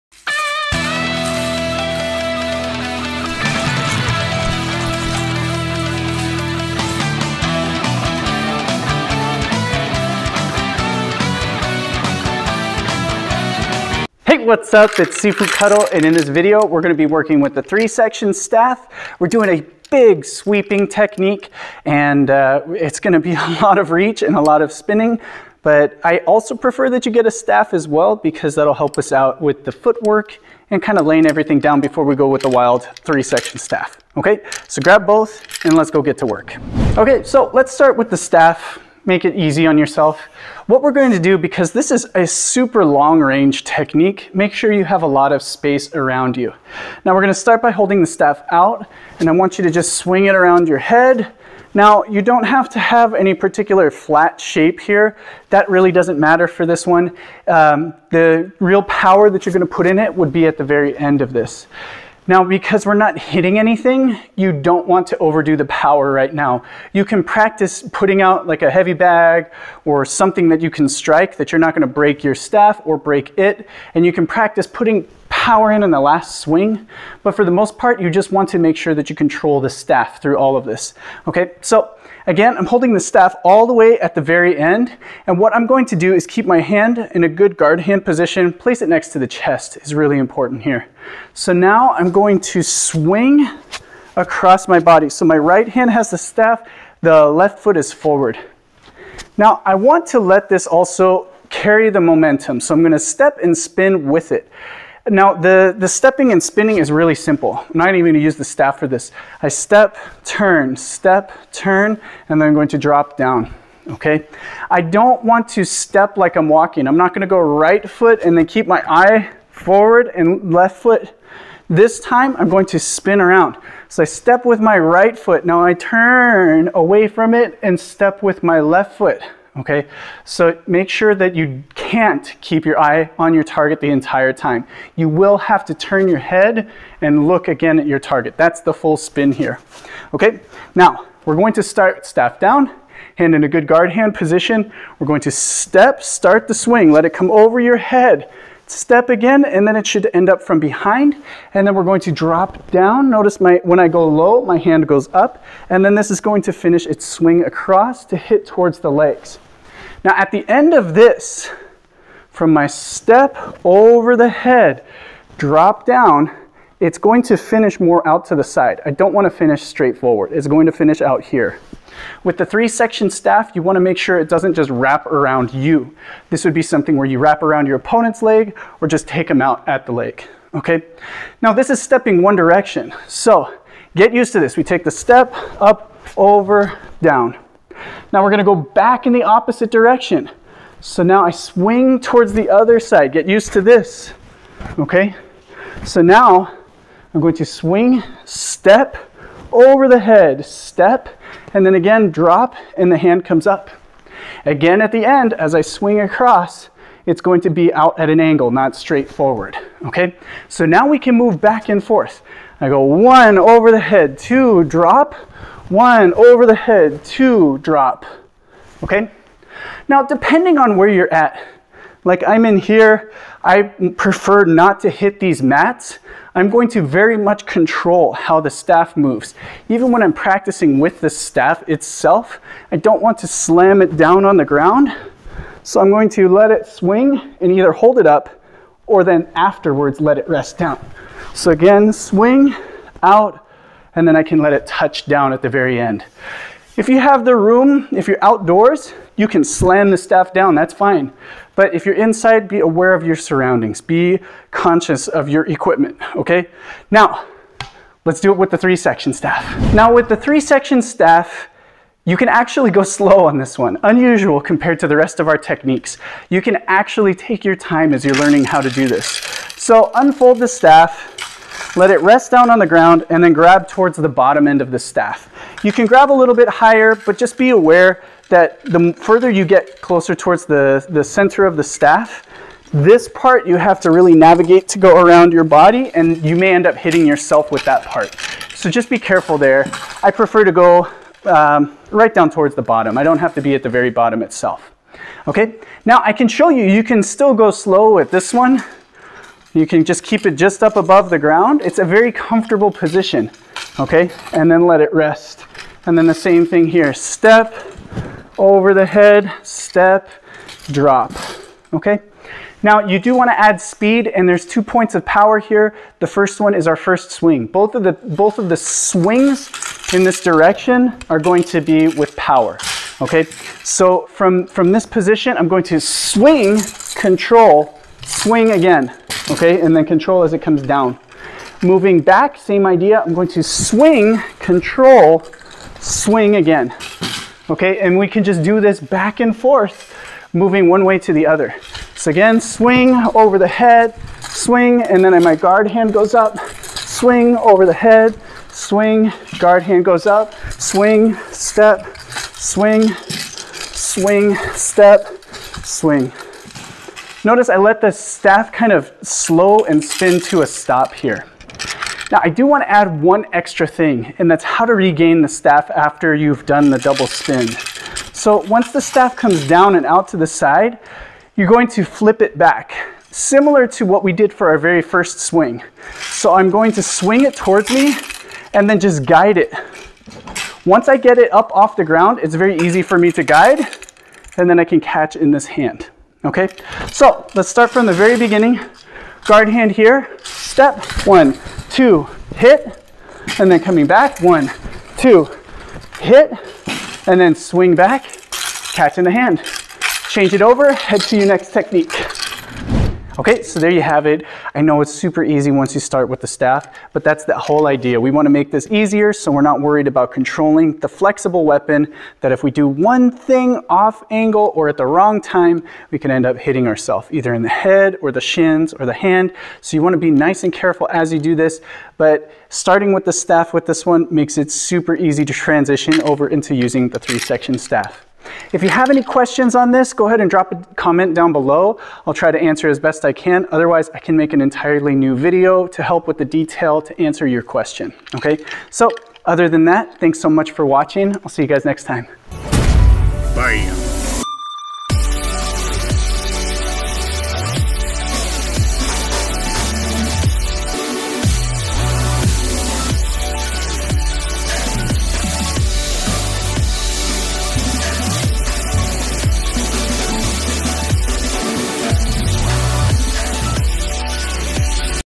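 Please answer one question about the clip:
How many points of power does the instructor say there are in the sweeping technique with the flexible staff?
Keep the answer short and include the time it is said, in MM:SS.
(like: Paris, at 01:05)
2, at 05:14.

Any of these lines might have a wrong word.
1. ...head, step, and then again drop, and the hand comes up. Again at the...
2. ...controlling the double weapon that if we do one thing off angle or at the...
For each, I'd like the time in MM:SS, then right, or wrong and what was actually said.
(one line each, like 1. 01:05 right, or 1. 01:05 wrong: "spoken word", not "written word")
1. 03:19 right
2. 06:50 wrong: "flexible", not "double".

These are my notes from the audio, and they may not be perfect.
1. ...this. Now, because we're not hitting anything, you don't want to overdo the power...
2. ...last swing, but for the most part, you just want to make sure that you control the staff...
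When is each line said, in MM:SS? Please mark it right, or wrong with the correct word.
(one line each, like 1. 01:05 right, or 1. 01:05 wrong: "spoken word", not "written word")
1. 01:01 right
2. 01:15 right.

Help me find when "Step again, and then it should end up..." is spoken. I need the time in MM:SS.
02:28.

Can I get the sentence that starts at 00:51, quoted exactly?
Now you don't have to have any particular flat shape here.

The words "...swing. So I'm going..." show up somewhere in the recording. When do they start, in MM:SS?
06:15.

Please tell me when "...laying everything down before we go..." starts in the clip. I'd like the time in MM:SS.
00:31.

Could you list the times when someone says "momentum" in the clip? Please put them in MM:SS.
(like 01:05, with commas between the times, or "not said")
01:42.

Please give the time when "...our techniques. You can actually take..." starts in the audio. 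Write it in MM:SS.
04:25.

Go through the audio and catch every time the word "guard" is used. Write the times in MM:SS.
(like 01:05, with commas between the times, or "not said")
01:27, 02:23, 05:45, 05:49, 06:29.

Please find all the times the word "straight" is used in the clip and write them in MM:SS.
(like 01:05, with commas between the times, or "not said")
02:49, 03:28.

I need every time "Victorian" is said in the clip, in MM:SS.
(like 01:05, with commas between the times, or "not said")
not said.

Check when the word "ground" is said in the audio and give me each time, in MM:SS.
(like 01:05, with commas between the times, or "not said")
03:54, 04:32, 05:01, 06:21.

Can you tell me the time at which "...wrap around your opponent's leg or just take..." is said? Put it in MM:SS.
02:57.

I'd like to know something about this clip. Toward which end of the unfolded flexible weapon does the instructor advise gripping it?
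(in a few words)
Bottom end.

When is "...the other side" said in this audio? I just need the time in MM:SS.
03:12.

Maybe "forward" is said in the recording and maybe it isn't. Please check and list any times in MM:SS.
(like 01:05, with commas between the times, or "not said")
01:37, 01:59, 02:49, 03:29.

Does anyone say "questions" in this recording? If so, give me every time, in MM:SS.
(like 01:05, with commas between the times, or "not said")
07:09, 07:17.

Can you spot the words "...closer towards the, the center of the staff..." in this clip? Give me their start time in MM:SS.
04:39.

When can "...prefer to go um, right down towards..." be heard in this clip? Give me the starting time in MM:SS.
04:50.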